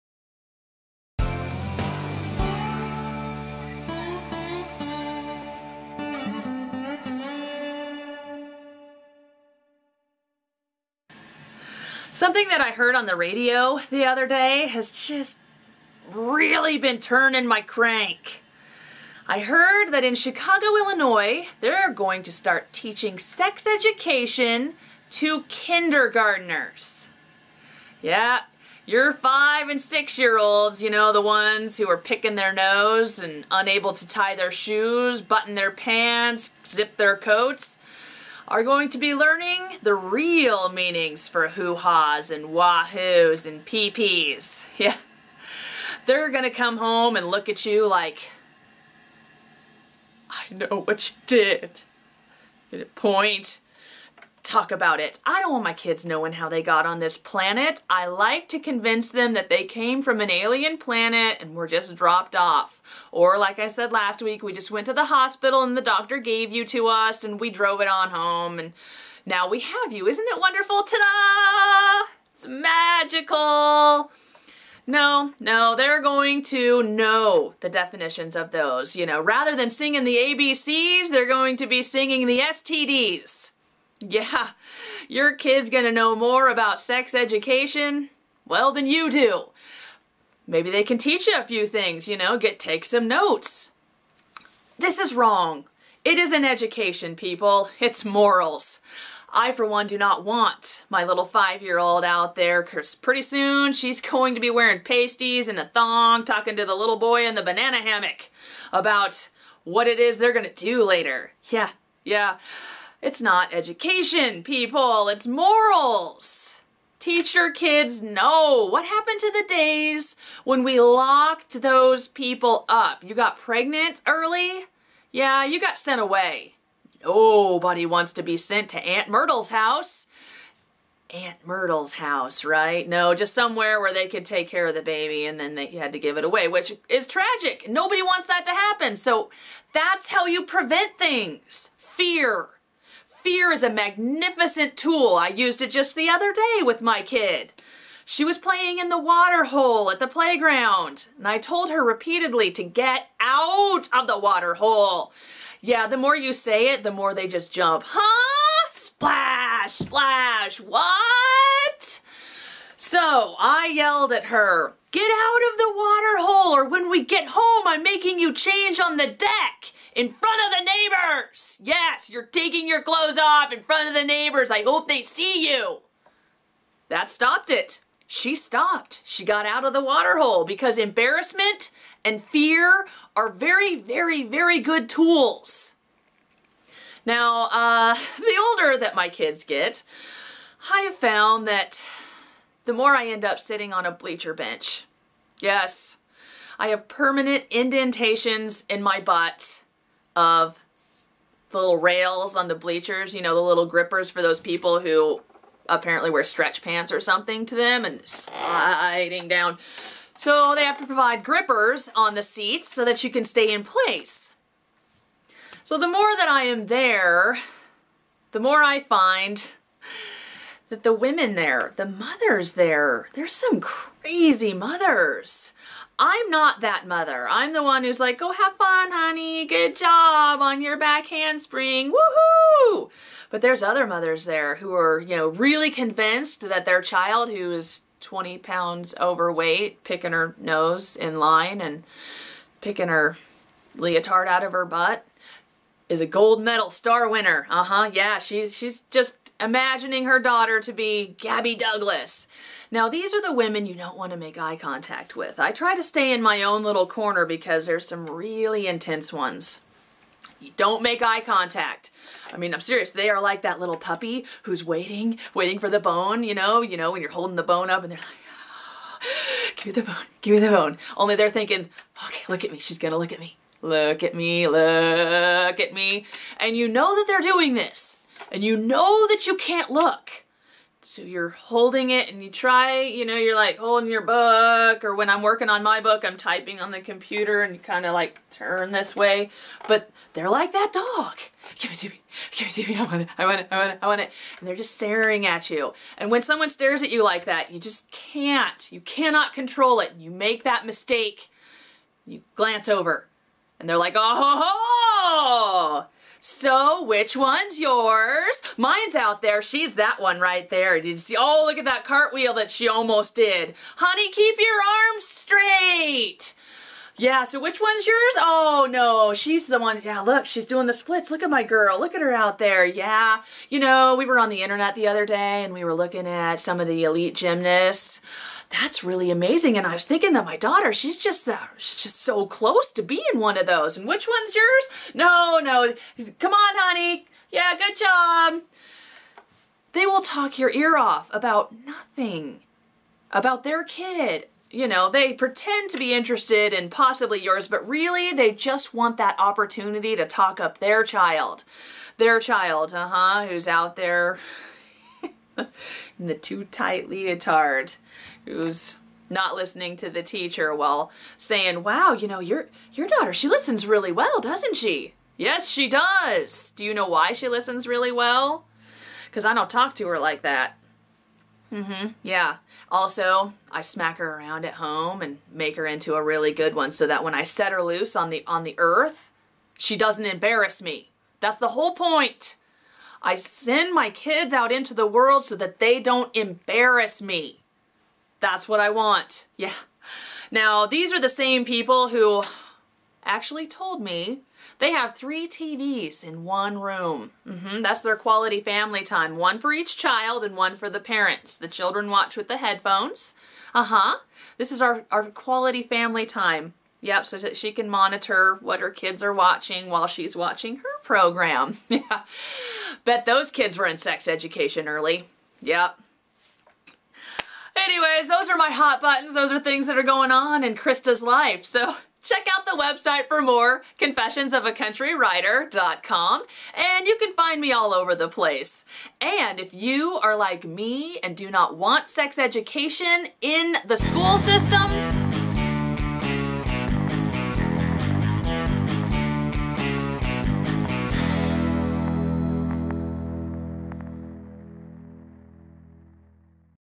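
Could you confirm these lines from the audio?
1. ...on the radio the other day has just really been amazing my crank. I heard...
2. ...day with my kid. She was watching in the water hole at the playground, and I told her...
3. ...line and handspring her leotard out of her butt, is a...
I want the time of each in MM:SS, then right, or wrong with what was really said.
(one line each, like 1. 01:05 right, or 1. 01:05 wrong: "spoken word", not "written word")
1. 00:12 wrong: "turning", not "amazing"
2. 02:26 wrong: "playing", not "watching"
3. 04:01 wrong: "picking", not "handspring".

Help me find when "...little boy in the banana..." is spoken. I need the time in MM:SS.
01:46.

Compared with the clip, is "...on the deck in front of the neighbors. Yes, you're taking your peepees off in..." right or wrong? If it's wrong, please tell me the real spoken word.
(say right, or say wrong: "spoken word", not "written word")
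wrong: "clothes", not "peepees".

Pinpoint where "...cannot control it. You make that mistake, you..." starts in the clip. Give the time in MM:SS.
04:58.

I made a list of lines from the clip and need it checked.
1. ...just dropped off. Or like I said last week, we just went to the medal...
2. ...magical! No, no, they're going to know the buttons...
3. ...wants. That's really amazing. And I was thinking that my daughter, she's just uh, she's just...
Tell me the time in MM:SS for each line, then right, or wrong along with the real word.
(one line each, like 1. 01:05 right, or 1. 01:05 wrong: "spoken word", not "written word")
1. 01:01 wrong: "hospital", not "medal"
2. 01:12 wrong: "definitions", not "buttons"
3. 05:27 wrong: "gymnasts", not "wants".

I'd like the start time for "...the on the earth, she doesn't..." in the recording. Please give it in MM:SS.
06:18.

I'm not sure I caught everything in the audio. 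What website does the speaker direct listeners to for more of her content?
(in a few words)
confessionsofacountrywriter.com.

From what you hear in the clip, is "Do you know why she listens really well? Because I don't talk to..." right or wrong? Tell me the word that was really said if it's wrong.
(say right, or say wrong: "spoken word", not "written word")
right.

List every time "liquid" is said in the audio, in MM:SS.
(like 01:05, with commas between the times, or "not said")
not said.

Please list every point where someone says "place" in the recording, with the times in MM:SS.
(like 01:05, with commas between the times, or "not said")
03:33, 07:08.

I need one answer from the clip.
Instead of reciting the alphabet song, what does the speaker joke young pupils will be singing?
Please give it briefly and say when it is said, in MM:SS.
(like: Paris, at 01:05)
the STDs, at 01:22.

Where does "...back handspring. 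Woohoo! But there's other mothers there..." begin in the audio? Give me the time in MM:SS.
03:50.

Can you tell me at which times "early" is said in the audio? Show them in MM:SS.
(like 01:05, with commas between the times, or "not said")
02:04, 06:54.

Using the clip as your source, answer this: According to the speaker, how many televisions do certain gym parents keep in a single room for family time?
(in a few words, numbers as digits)
3.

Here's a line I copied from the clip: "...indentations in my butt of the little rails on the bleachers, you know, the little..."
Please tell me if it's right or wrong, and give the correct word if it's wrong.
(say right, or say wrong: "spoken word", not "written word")
right.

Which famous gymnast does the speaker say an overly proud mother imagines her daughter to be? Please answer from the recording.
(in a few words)
Gabby Douglas.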